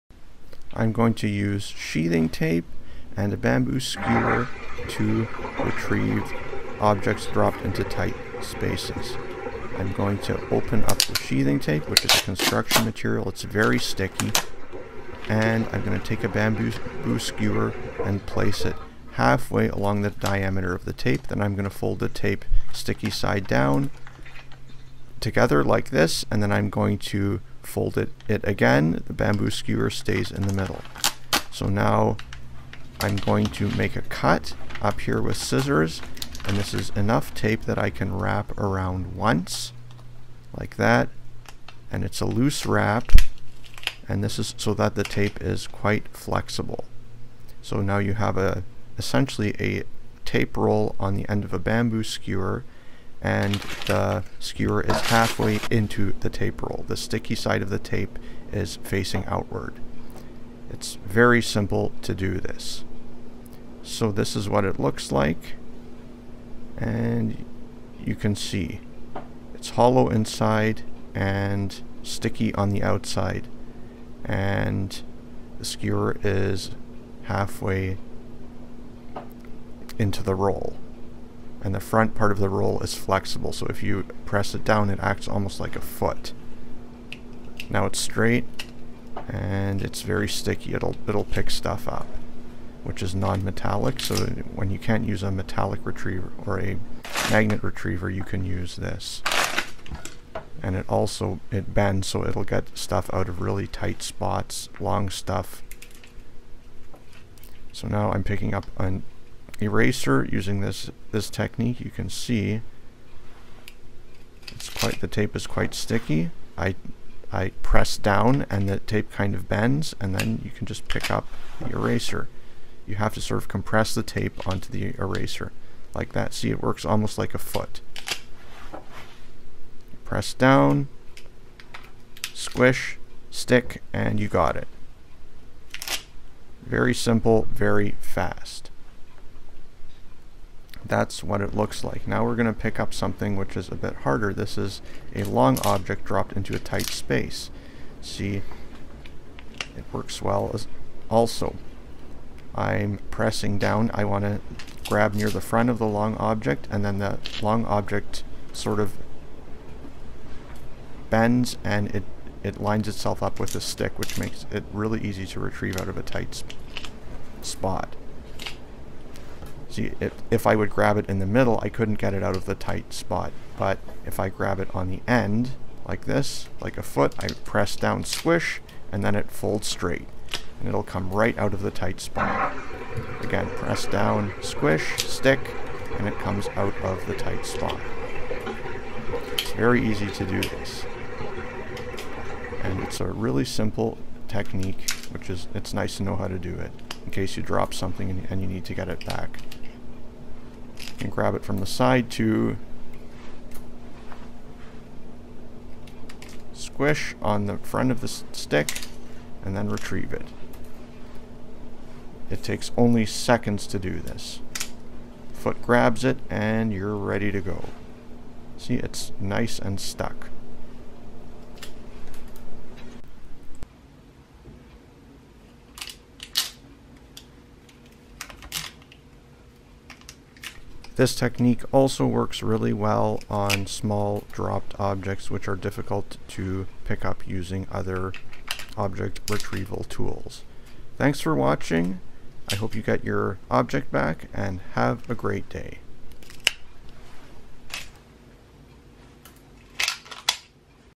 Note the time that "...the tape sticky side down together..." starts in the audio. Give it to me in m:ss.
0:21.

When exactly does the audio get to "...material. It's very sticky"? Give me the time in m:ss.
0:12.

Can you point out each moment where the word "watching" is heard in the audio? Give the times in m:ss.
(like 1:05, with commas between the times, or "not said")
4:01.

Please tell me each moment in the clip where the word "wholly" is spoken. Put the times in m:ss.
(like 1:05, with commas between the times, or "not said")
not said.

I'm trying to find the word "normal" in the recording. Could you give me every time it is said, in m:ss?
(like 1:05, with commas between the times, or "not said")
not said.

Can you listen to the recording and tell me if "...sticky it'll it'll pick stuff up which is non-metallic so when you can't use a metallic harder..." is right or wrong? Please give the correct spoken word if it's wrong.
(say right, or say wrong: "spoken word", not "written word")
wrong: "retriever", not "harder".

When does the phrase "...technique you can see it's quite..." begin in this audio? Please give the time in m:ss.
1:51.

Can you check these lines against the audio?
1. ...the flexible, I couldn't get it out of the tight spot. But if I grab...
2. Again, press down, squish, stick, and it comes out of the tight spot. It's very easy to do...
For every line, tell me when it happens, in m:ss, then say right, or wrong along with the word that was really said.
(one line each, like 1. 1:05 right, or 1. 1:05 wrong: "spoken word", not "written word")
1. 2:51 wrong: "middle", not "flexible"
2. 3:03 right.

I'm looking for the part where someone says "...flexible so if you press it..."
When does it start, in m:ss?
1:22.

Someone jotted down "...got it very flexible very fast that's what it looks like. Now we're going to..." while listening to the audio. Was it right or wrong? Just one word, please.
wrong.